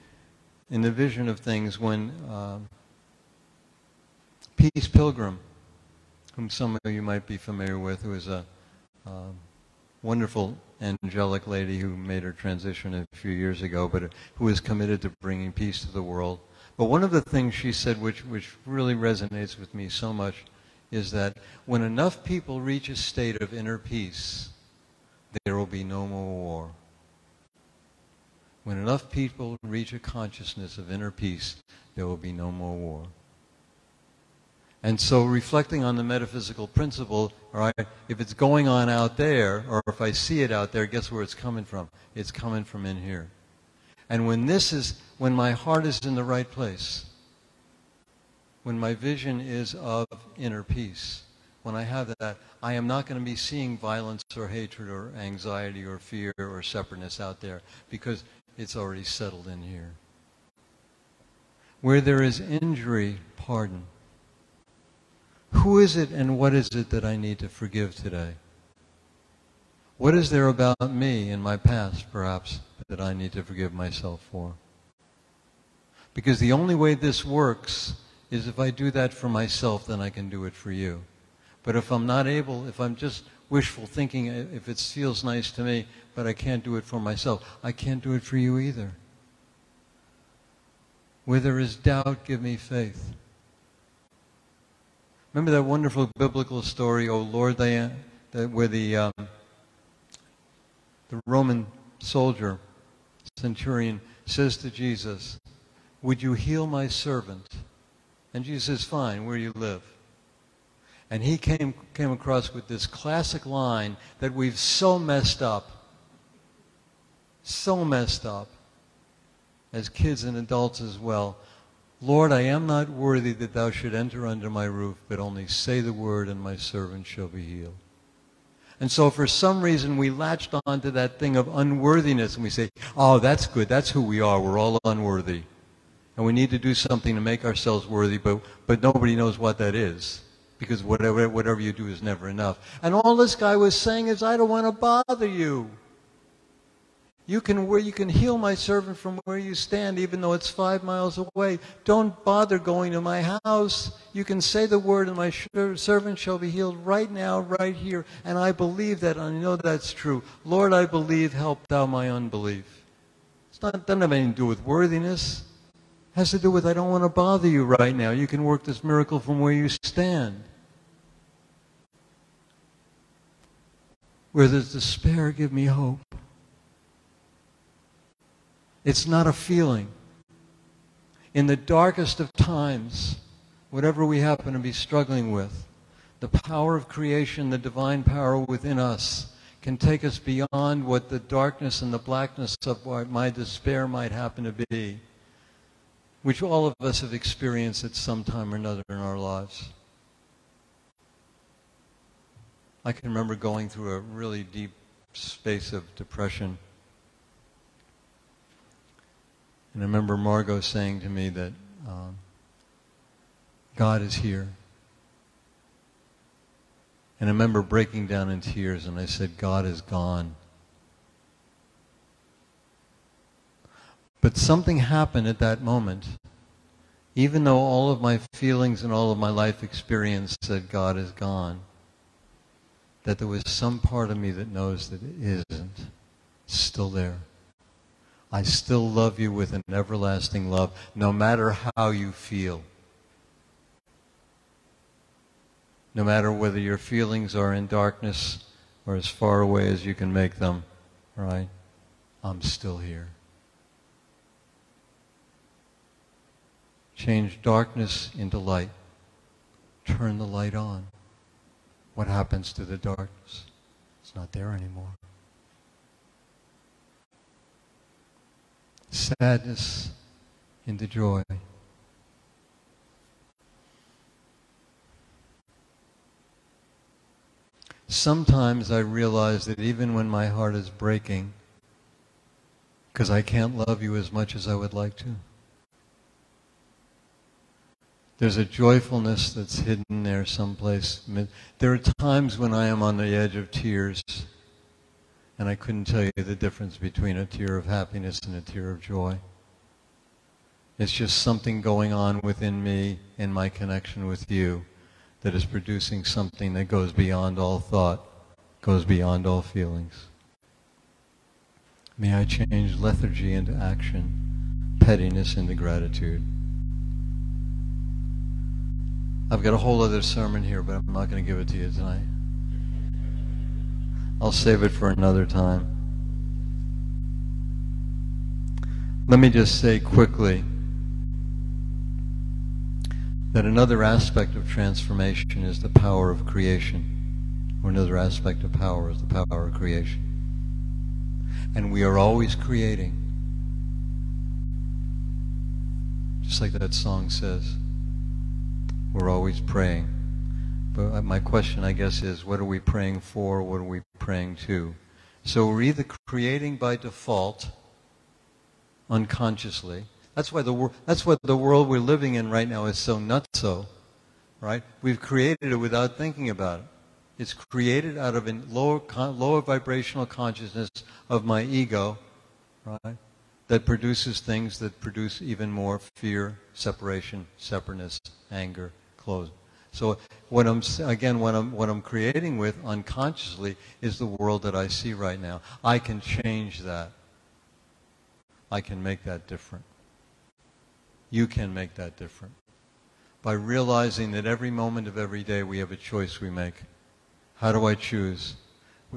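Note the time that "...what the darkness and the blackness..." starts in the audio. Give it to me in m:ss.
3:10.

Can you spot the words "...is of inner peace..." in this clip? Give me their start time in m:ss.
0:49.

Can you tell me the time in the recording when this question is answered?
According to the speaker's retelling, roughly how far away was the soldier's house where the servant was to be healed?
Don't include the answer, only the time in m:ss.
2:30.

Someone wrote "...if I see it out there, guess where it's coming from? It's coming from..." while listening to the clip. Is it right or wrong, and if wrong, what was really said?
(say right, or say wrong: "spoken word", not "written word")
right.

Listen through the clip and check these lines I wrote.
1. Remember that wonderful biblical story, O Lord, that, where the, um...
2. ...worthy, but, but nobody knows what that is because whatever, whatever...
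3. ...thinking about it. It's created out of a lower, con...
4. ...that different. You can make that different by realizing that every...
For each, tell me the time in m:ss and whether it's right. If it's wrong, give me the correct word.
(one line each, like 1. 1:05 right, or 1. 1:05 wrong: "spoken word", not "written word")
1. 1:35 right
2. 2:17 right
3. 6:05 right
4. 6:29 right.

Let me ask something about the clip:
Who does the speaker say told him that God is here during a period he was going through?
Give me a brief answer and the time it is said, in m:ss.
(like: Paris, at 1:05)
Margot, at 3:30.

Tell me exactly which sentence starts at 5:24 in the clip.
I'll save it for another time.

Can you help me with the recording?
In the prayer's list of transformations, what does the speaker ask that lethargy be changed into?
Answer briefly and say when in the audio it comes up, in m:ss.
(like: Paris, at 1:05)
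action, at 5:13.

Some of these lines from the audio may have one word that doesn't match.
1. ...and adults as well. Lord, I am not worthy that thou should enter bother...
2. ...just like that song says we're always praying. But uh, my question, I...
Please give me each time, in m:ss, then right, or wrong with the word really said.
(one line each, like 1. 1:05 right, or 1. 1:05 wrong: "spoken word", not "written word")
1. 2:00 wrong: "under", not "bother"
2. 5:46 right.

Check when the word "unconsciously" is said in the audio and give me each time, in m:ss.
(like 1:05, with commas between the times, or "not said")
5:58, 6:22.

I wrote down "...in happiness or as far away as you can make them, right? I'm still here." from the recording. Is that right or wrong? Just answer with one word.
wrong.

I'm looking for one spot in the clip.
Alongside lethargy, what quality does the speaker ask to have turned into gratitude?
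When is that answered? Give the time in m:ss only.
5:14.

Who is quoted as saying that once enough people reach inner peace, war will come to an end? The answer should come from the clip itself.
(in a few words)
Peace Pilgrim.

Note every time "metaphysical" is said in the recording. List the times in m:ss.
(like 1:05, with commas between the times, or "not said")
0:36.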